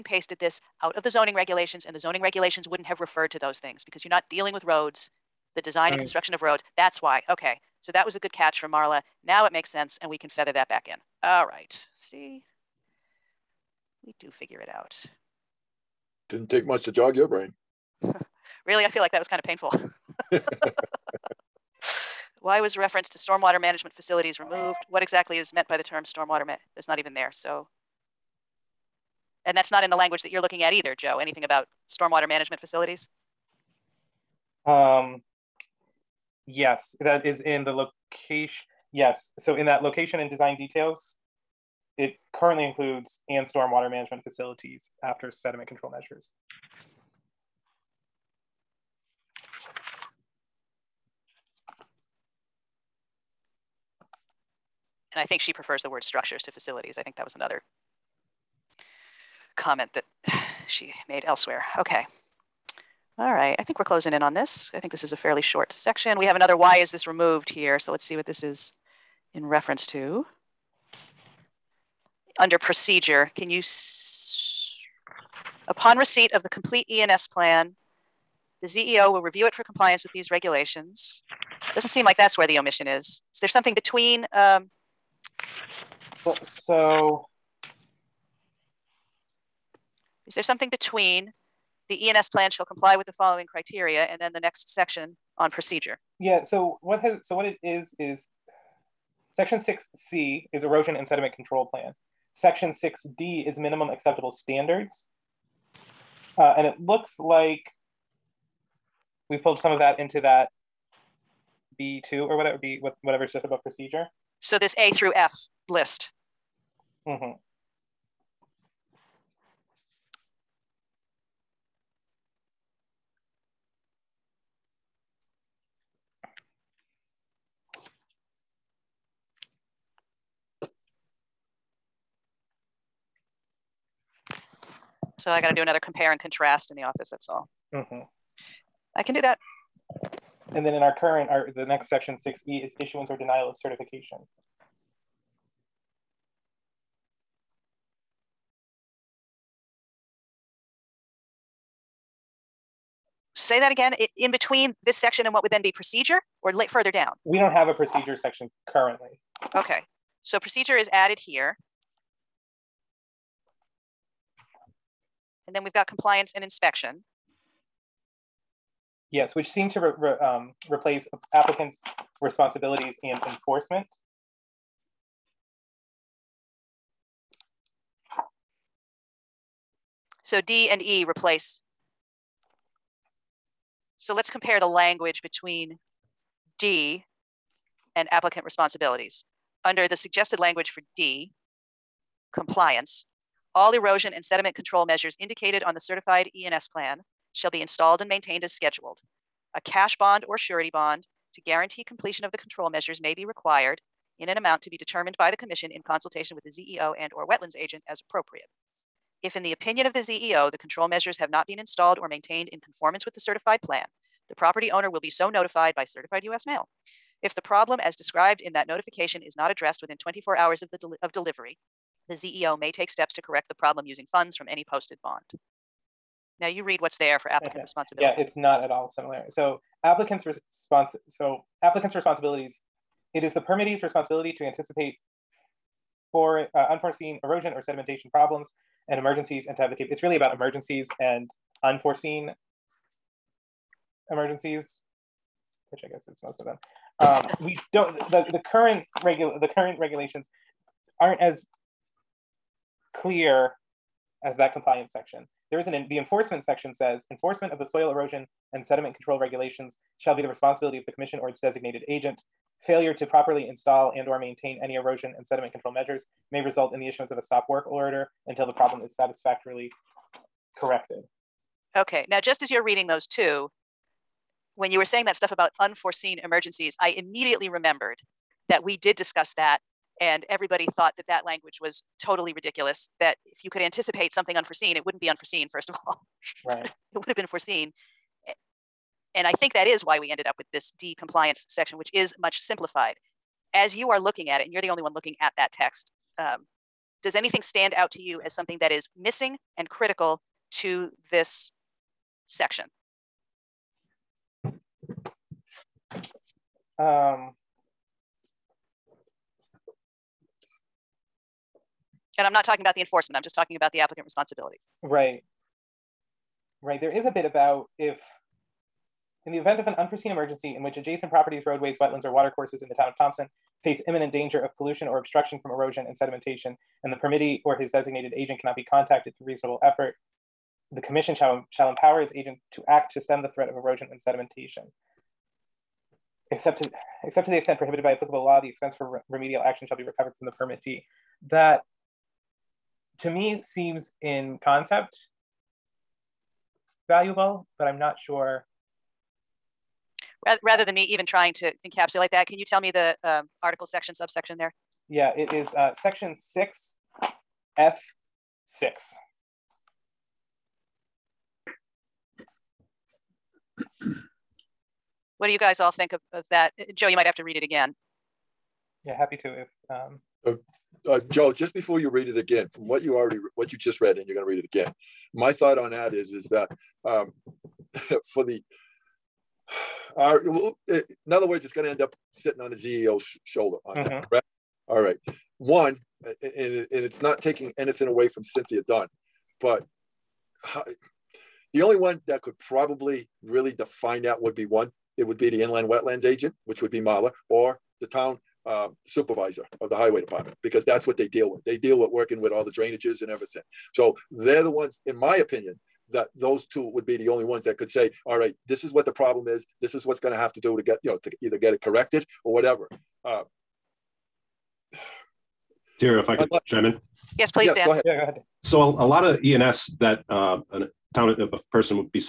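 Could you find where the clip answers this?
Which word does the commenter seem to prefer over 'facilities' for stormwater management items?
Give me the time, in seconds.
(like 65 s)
56 s.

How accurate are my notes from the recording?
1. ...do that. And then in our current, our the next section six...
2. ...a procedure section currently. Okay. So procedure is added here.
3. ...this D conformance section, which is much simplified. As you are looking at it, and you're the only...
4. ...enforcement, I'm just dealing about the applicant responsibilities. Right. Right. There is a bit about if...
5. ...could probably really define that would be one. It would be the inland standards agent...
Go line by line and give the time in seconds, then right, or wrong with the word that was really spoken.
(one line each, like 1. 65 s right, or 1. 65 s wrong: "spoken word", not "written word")
1. 139 s right
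2. 157 s right
3. 290 s wrong: "compliance", not "conformance"
4. 312 s wrong: "talking", not "dealing"
5. 392 s wrong: "wetlands", not "standards".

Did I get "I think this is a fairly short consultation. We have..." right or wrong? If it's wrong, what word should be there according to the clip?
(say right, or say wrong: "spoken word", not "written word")
wrong: "section", not "consultation".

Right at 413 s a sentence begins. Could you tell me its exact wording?
Uh, Tara, if I uh, could uh, chime in.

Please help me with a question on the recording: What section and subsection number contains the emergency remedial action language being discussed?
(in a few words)
Section 6 F6.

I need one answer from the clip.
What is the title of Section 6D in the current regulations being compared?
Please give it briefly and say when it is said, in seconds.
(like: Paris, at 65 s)
minimum acceptable standards, at 103 s.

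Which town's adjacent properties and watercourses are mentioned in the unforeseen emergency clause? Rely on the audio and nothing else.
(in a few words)
Thompson.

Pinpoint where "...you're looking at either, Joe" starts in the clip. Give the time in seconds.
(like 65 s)
30 s.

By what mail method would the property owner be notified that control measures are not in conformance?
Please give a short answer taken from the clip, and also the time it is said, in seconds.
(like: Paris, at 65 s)
certified US mail, at 215 s.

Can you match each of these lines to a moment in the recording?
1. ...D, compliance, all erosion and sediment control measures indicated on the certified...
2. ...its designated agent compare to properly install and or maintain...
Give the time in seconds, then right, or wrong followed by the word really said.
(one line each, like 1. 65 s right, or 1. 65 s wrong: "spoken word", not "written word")
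1. 190 s right
2. 261 s wrong: "failure", not "compare".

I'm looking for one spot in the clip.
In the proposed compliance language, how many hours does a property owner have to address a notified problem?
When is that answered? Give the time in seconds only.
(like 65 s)
219 s.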